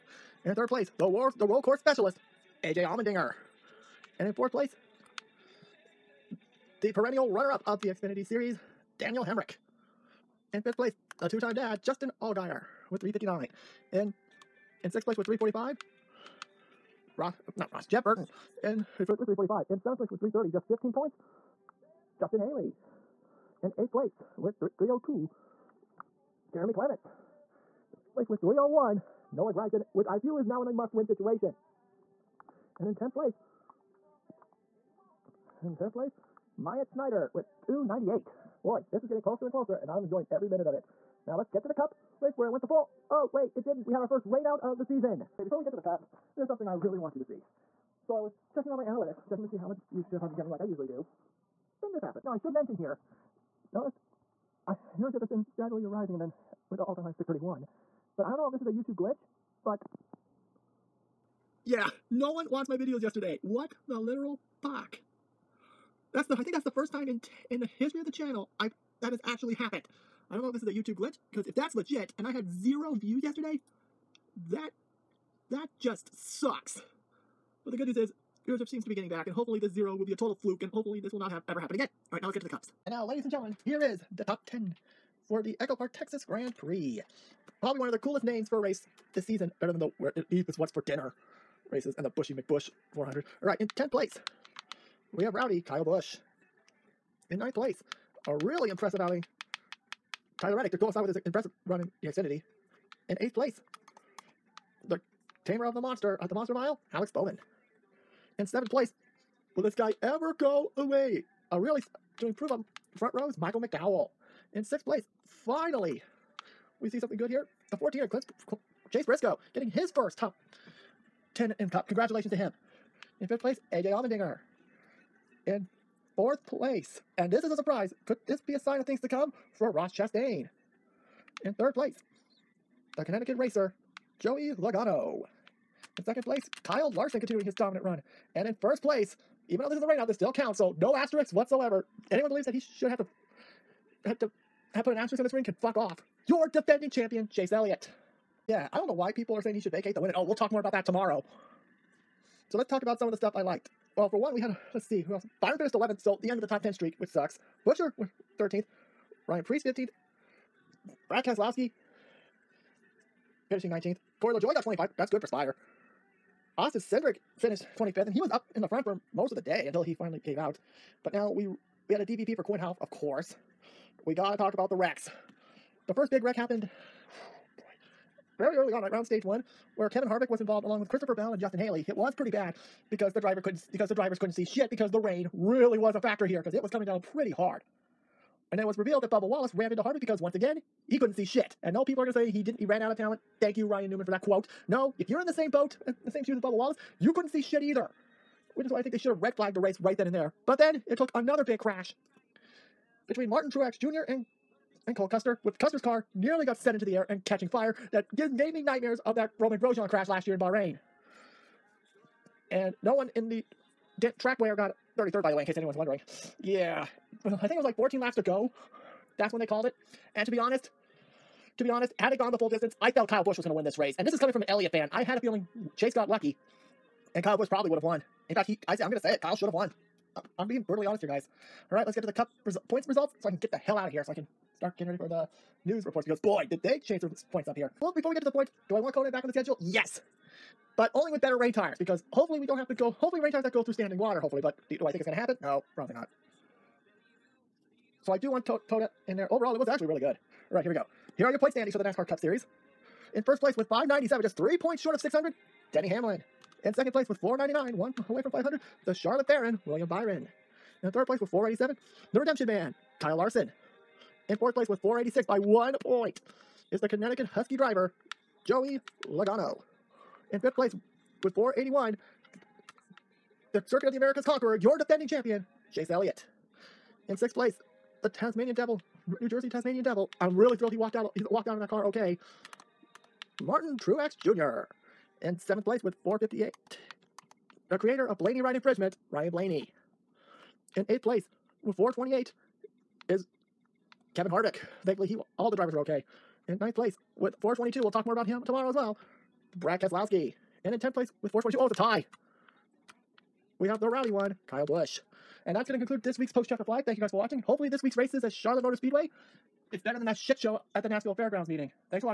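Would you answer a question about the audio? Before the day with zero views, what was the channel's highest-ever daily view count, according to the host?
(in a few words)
631.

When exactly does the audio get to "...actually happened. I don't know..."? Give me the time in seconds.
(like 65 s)
69 s.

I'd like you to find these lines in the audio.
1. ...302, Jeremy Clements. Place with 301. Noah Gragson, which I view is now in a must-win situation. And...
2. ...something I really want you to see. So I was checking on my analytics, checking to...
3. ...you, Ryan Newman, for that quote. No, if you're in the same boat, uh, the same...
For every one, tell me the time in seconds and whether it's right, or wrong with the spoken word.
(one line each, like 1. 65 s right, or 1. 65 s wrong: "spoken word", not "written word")
1. 24 s right
2. 46 s right
3. 193 s right.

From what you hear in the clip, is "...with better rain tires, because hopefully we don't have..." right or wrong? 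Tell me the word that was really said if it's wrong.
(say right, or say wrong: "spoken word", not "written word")
right.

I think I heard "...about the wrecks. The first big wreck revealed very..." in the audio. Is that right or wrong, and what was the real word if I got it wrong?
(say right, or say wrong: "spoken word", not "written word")
wrong: "happened", not "revealed".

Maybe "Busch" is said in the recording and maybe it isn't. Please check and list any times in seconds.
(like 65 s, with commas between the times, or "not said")
95 s, 223 s, 227 s, 304 s.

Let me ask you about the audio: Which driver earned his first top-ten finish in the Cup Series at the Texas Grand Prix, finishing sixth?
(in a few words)
Chase Briscoe.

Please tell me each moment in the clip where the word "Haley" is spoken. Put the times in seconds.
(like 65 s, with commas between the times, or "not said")
22 s, 181 s.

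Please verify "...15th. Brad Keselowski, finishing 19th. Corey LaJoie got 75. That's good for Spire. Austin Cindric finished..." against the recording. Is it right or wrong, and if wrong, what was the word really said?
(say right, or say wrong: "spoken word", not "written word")
wrong: "25", not "75".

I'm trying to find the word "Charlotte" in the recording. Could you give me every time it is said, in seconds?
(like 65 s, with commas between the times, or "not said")
258 s, 308 s.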